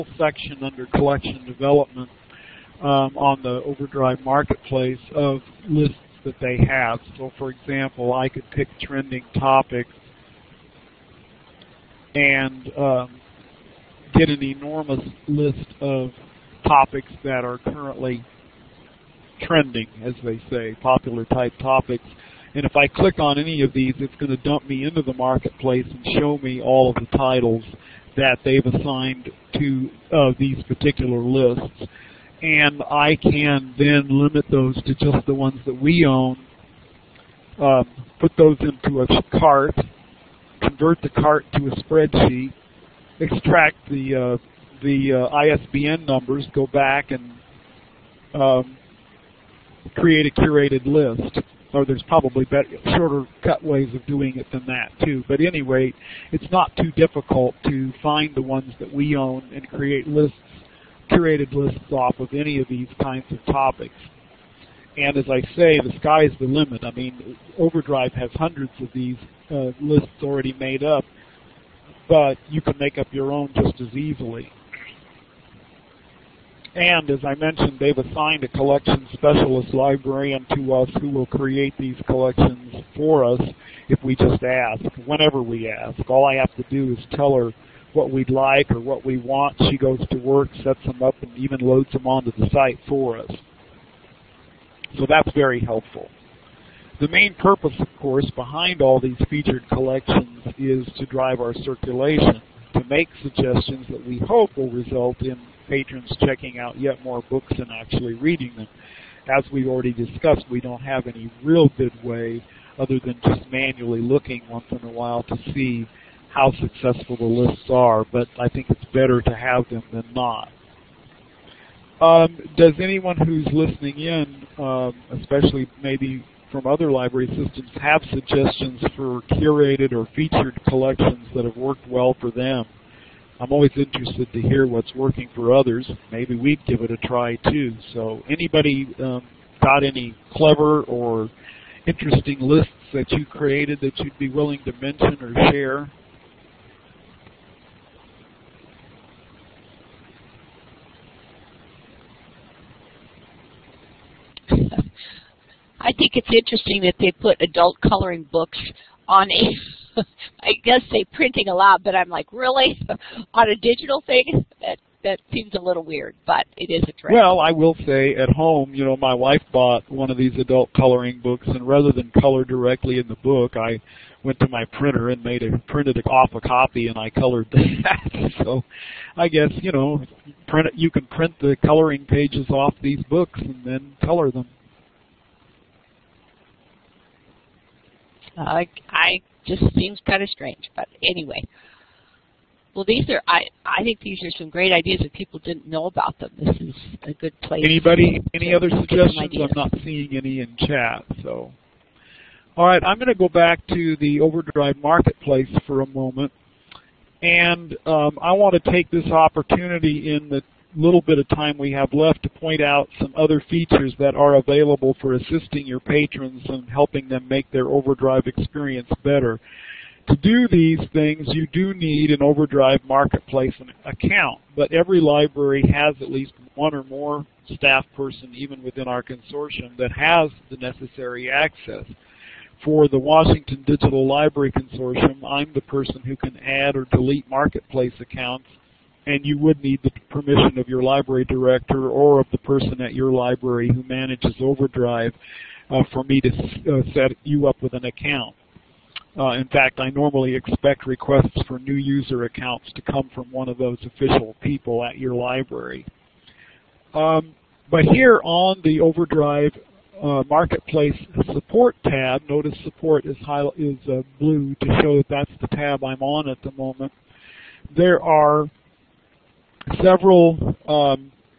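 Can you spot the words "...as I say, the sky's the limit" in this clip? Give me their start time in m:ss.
1:05.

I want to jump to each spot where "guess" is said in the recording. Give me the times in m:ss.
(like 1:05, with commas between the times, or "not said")
2:40, 2:59.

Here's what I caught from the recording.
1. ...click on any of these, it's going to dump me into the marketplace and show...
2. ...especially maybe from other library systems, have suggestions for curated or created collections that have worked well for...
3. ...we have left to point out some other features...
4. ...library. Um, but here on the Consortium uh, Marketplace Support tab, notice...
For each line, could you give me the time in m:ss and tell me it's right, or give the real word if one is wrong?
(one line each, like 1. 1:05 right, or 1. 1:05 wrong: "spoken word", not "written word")
1. 0:22 right
2. 2:05 wrong: "featured", not "created"
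3. 3:31 right
4. 4:15 wrong: "Overdrive", not "Consortium".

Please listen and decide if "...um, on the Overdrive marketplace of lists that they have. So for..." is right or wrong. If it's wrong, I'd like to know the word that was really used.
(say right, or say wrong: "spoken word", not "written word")
right.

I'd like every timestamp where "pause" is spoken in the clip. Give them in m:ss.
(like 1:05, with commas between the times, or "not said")
not said.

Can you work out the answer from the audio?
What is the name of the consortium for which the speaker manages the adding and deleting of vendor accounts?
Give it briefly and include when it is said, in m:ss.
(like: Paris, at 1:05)
Washington Digital Library Consortium, at 3:52.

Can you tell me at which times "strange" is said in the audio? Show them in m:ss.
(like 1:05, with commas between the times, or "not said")
3:10.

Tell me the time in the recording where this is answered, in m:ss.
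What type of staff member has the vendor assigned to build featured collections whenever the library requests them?
1:18.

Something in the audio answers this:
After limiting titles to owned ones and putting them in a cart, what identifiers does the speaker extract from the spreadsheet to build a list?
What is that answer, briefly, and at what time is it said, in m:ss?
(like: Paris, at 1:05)
ISBN numbers, at 0:45.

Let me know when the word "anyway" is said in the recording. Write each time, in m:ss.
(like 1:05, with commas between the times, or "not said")
0:55, 3:11.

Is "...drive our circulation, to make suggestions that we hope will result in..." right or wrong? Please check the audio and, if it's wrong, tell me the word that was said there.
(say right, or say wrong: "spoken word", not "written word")
right.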